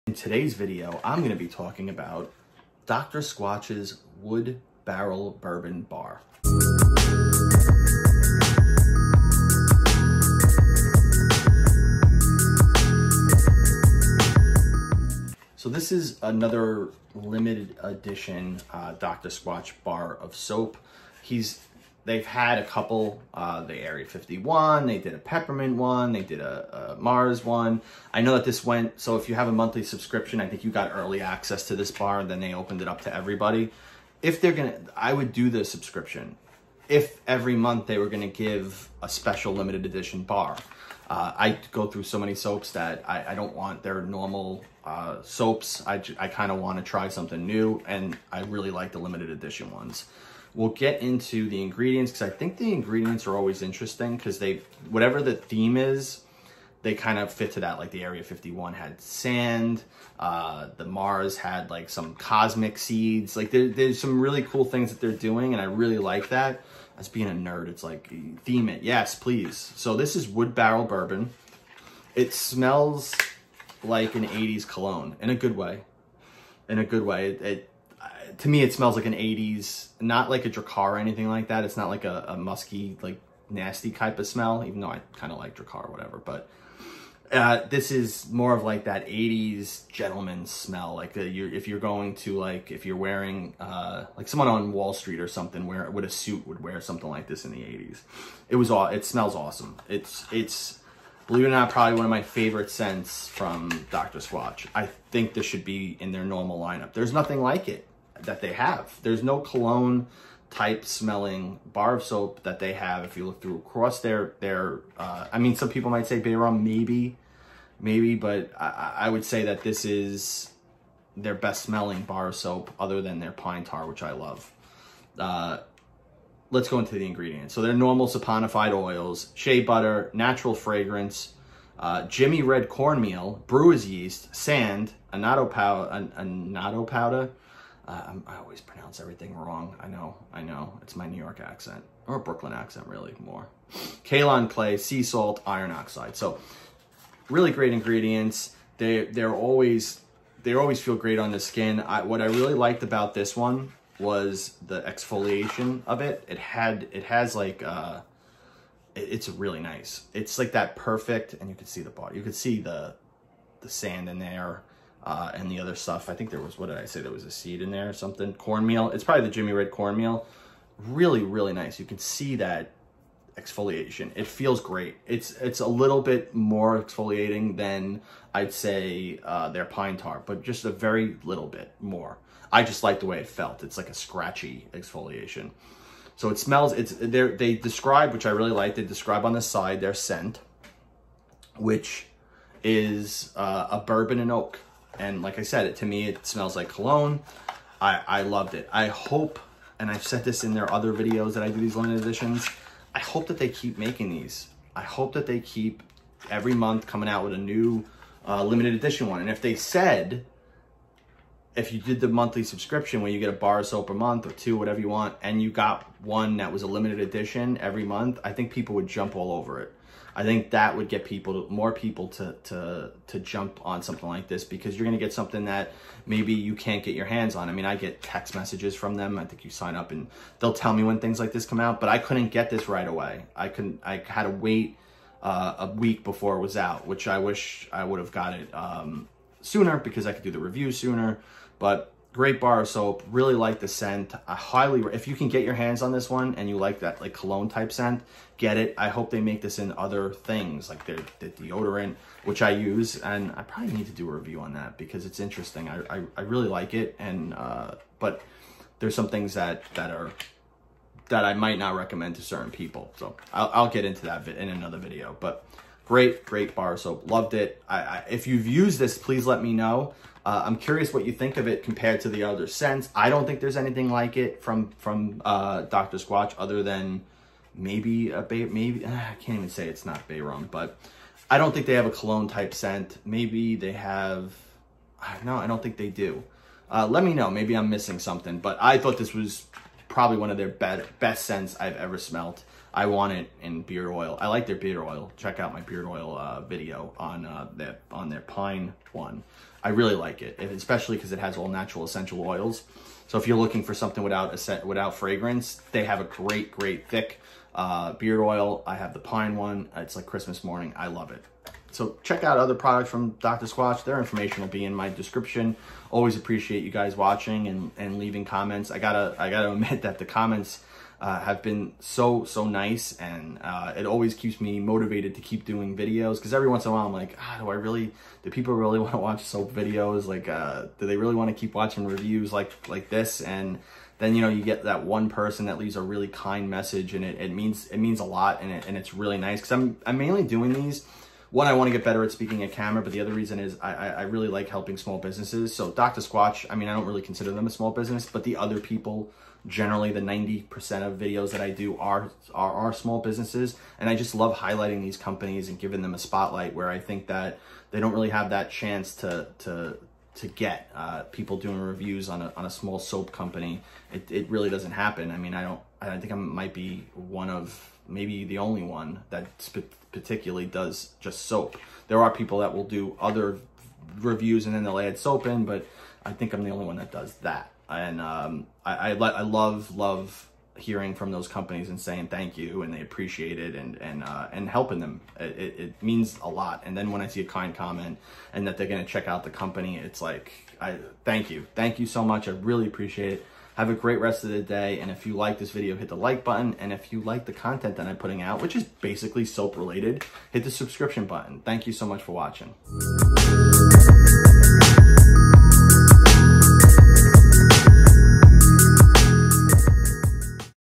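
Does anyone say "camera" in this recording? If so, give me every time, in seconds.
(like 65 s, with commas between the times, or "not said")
342 s.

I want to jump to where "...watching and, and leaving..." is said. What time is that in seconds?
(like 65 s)
316 s.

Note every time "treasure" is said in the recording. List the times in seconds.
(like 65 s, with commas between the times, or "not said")
not said.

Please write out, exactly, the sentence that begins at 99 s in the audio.
It's, it's, believe it or not, probably one of my favorite scents from Dr.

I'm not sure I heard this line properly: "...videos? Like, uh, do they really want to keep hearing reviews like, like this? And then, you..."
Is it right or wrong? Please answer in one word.
wrong.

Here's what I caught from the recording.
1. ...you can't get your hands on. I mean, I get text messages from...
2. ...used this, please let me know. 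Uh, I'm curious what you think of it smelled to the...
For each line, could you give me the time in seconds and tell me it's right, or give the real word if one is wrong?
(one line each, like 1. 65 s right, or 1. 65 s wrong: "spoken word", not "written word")
1. 226 s right
2. 268 s wrong: "compared", not "smelled".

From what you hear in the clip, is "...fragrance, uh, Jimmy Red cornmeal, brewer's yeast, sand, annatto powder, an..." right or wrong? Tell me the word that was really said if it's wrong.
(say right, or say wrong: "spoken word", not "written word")
right.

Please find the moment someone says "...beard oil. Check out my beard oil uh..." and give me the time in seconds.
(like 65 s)
294 s.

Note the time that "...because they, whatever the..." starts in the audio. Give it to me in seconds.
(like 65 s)
54 s.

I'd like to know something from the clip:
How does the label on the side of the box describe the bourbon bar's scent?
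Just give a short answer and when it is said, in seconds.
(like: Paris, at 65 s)
bourbon and oak, at 193 s.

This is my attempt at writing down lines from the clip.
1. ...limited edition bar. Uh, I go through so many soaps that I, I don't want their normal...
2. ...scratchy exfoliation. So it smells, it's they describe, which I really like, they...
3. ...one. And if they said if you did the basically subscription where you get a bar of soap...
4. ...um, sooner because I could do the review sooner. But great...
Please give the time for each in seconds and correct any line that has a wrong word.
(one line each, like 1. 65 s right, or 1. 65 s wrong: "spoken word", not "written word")
1. 39 s right
2. 183 s right
3. 209 s wrong: "monthly", not "basically"
4. 238 s right.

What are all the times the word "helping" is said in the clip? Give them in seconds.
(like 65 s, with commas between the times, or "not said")
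344 s, 384 s.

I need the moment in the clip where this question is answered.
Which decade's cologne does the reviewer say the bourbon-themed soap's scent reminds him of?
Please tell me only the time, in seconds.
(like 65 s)
74 s.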